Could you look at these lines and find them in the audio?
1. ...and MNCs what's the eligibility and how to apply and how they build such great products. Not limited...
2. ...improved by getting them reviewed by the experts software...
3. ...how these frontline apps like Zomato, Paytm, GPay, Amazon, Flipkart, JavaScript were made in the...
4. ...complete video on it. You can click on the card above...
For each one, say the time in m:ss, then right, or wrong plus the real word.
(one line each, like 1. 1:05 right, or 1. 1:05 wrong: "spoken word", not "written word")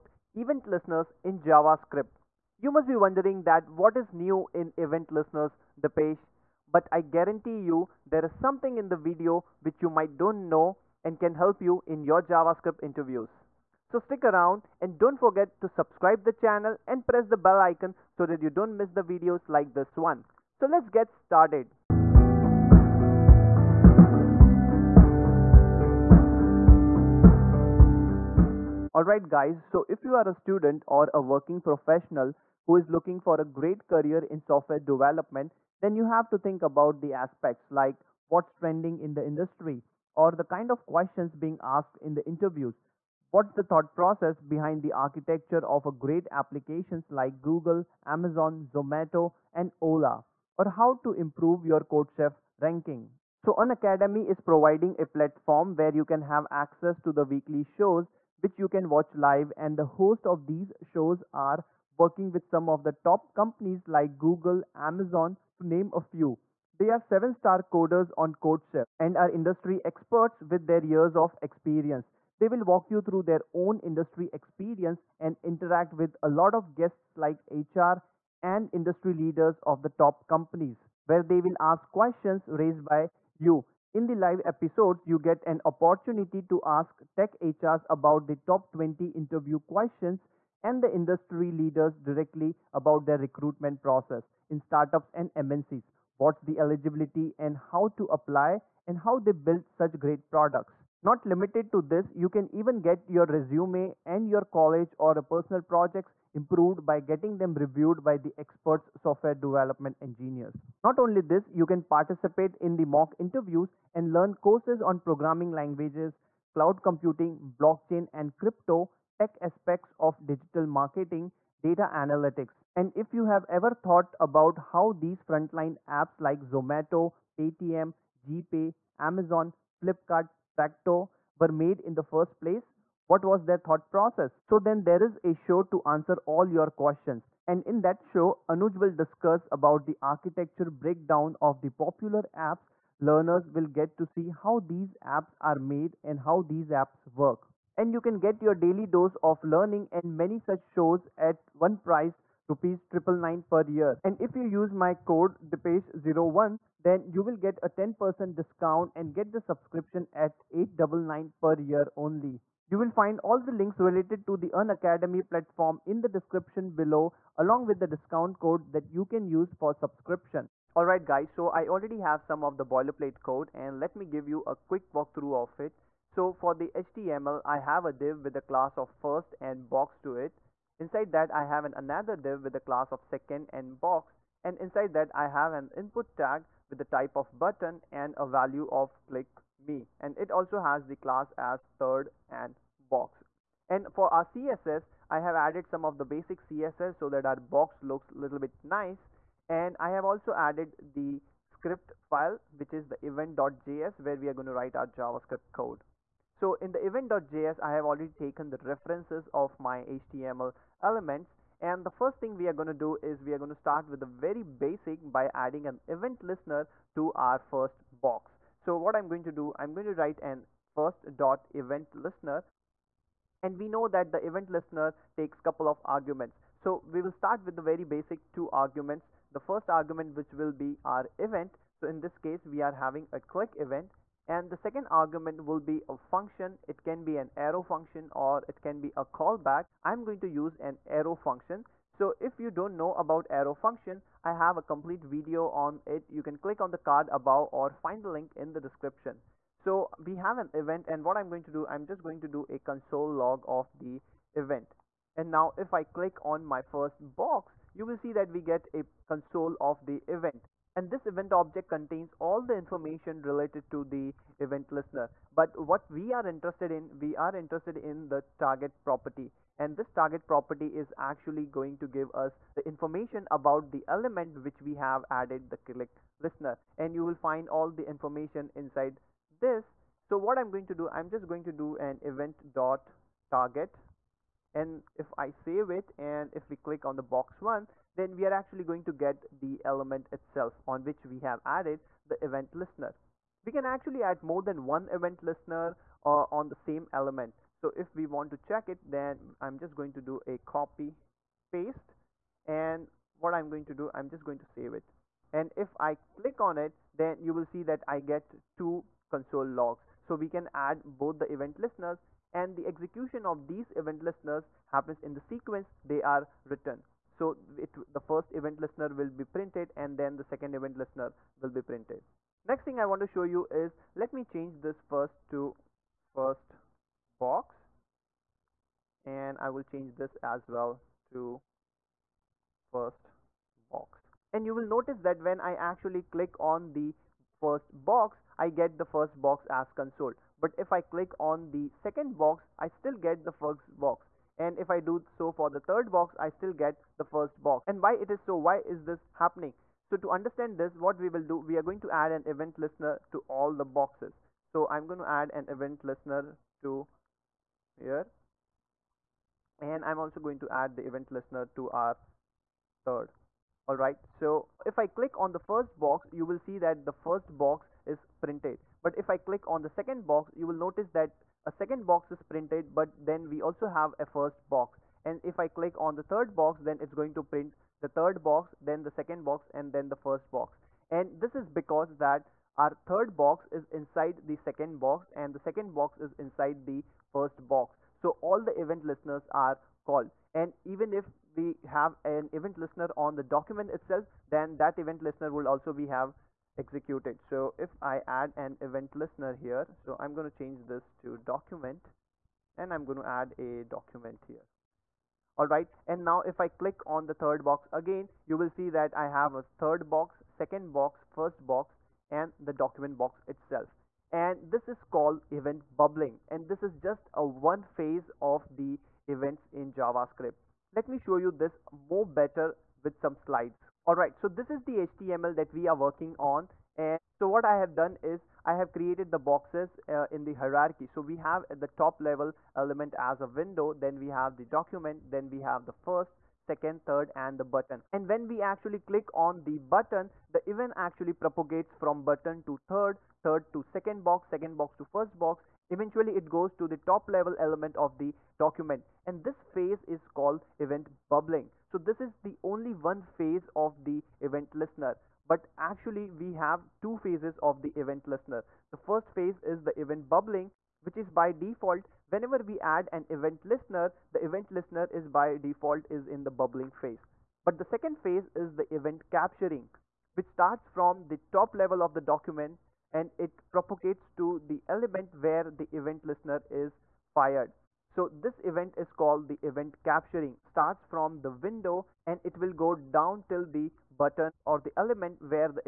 1. 1:35 right
2. 1:46 right
3. 2:04 wrong: "Practo", not "JavaScript"
4. 4:04 right.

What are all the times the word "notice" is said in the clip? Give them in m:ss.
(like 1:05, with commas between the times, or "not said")
5:34, 6:10.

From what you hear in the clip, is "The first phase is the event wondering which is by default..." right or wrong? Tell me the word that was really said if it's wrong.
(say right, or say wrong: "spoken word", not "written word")
wrong: "bubbling", not "wondering".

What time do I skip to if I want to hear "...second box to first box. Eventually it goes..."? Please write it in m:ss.
7:24.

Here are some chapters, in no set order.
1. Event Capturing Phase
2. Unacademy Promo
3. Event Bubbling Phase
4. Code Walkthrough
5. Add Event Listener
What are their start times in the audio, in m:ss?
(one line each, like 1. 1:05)
1. 7:37
2. 0:28
3. 5:25
4. 2:50
5. 3:35.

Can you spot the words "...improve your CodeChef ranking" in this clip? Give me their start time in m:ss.
0:51.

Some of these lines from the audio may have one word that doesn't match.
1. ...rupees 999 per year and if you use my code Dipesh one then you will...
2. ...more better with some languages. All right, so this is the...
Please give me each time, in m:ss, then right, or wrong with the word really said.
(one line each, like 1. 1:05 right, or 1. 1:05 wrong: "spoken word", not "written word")
1. 2:32 right
2. 7:01 wrong: "slides", not "languages".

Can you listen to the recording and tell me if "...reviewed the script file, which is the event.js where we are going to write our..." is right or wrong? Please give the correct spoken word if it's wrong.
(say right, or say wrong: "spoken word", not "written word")
wrong: "added", not "reviewed".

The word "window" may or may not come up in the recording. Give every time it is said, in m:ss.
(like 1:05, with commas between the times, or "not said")
7:13, 8:01.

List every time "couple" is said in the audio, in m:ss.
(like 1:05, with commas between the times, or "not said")
3:45.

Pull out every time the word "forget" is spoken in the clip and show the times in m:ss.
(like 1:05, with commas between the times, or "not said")
0:15.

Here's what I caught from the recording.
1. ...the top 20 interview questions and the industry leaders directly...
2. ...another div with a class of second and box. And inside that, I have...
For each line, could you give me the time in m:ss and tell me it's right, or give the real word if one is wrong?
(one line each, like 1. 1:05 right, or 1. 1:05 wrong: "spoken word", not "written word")
1. 1:28 right
2. 3:01 right.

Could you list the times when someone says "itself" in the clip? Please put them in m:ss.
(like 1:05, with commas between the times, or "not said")
4:50, 6:33, 6:53.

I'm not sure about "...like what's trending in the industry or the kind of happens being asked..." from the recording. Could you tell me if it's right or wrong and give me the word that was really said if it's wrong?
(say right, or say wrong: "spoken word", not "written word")
wrong: "questions", not "happens".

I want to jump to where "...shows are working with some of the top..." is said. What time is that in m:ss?
1:00.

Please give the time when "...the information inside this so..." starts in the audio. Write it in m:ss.
4:37.